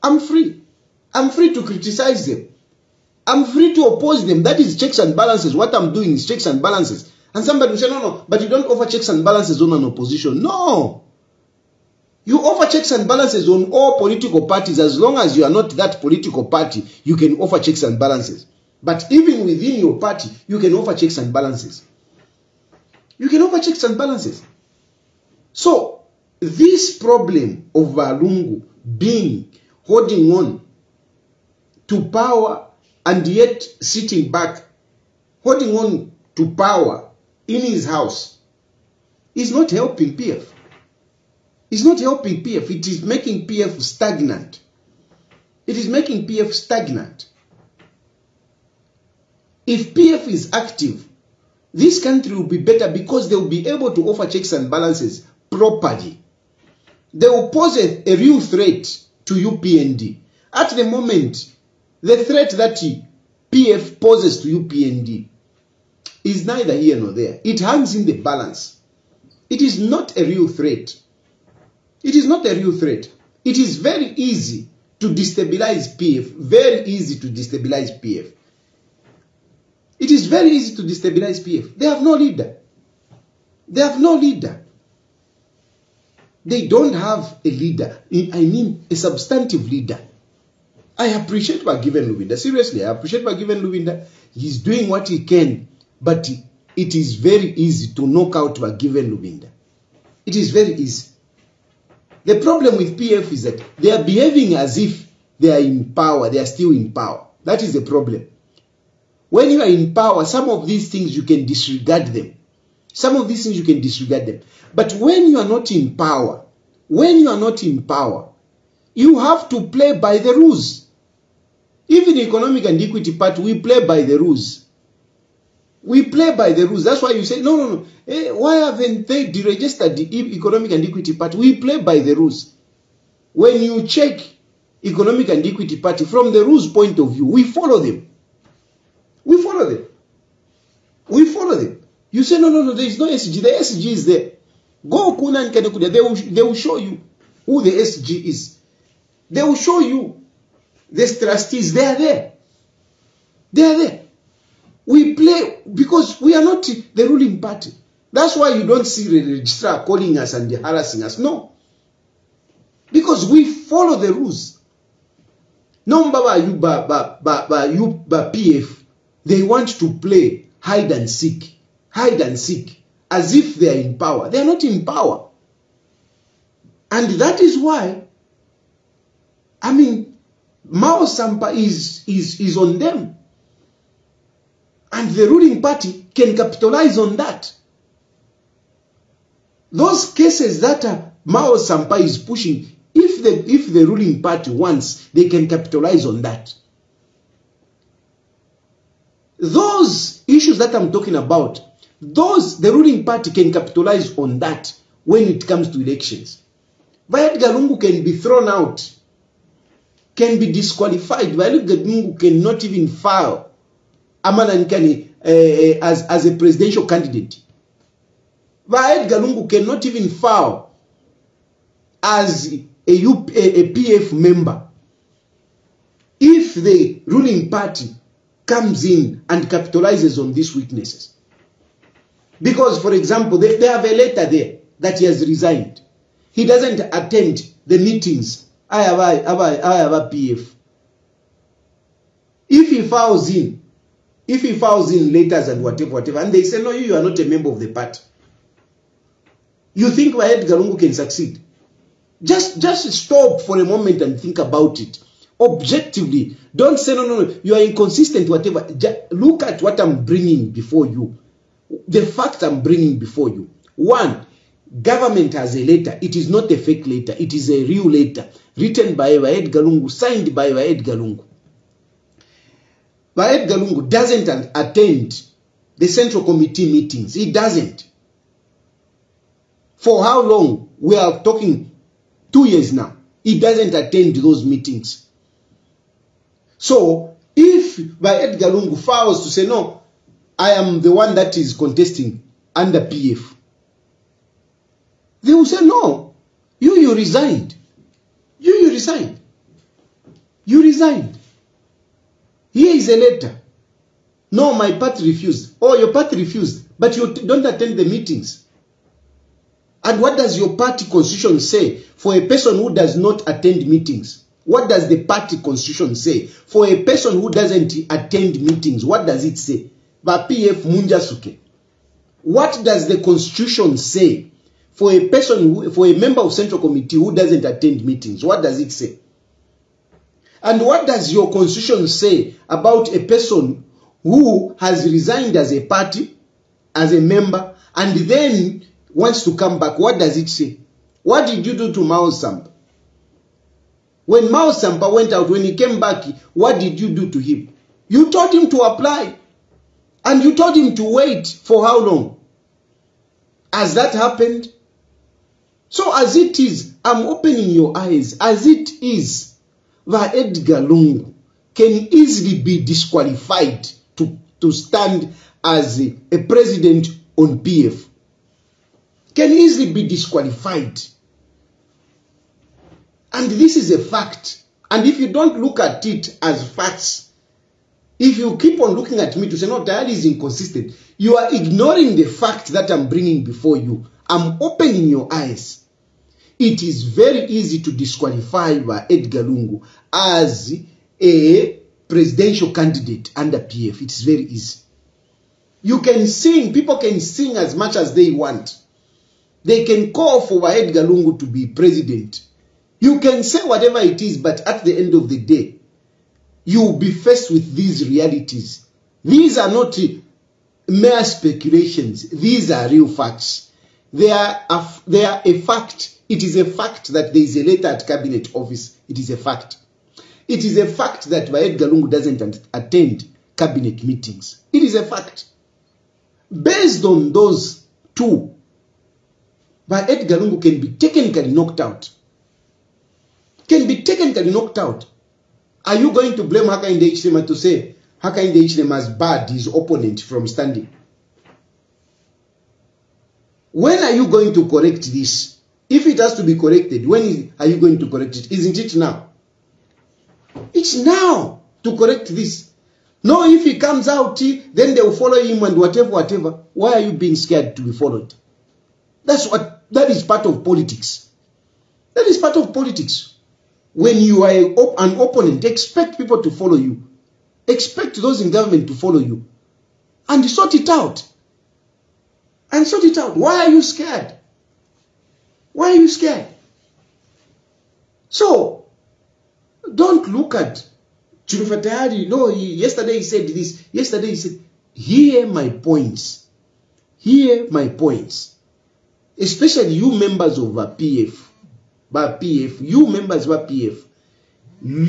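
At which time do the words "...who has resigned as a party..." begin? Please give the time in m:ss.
5:34.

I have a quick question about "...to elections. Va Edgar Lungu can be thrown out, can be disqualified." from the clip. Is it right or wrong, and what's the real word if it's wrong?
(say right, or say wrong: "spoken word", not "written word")
right.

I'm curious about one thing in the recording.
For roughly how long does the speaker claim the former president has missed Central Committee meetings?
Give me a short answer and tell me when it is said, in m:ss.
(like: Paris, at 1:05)
2 years, at 4:42.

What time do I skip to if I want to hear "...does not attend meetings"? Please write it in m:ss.
5:12.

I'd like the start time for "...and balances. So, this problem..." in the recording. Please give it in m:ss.
0:23.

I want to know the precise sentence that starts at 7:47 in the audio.
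Expect those in government to follow you.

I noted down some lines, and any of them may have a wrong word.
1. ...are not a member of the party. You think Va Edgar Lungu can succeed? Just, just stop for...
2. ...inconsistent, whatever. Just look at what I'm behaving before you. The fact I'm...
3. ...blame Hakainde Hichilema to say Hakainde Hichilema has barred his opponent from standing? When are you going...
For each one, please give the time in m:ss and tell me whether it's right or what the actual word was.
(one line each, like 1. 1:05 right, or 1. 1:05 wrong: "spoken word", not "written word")
1. 4:06 right
2. 4:17 wrong: "bringing", not "behaving"
3. 7:16 right.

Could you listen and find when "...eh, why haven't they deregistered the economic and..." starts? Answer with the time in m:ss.
2:08.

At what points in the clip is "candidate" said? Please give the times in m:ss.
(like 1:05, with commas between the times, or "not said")
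3:36, 6:32.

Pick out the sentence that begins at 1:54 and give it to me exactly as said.
But when you are not in power, when you are not in power, you have to play by the rules.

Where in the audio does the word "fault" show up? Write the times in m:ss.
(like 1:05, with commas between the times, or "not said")
not said.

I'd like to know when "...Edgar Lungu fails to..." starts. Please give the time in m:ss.
4:47.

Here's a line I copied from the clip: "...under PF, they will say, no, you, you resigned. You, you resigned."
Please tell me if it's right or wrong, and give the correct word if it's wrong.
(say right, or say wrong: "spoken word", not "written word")
right.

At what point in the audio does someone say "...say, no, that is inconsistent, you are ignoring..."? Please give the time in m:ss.
6:19.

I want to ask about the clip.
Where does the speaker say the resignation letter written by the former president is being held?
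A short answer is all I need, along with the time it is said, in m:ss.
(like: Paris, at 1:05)
cabinet office, at 6:57.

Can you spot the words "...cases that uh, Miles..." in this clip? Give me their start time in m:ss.
3:10.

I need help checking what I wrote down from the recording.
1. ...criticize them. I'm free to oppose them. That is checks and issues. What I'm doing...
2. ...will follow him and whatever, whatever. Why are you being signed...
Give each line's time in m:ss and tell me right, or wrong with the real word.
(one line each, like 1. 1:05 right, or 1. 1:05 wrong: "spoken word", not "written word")
1. 0:01 wrong: "balances", not "issues"
2. 7:34 wrong: "scared", not "signed".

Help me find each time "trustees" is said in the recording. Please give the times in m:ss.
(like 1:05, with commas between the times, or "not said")
2:31.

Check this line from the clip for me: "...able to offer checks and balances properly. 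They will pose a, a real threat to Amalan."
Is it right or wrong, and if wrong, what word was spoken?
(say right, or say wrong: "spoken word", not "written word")
wrong: "UPND", not "Amalan".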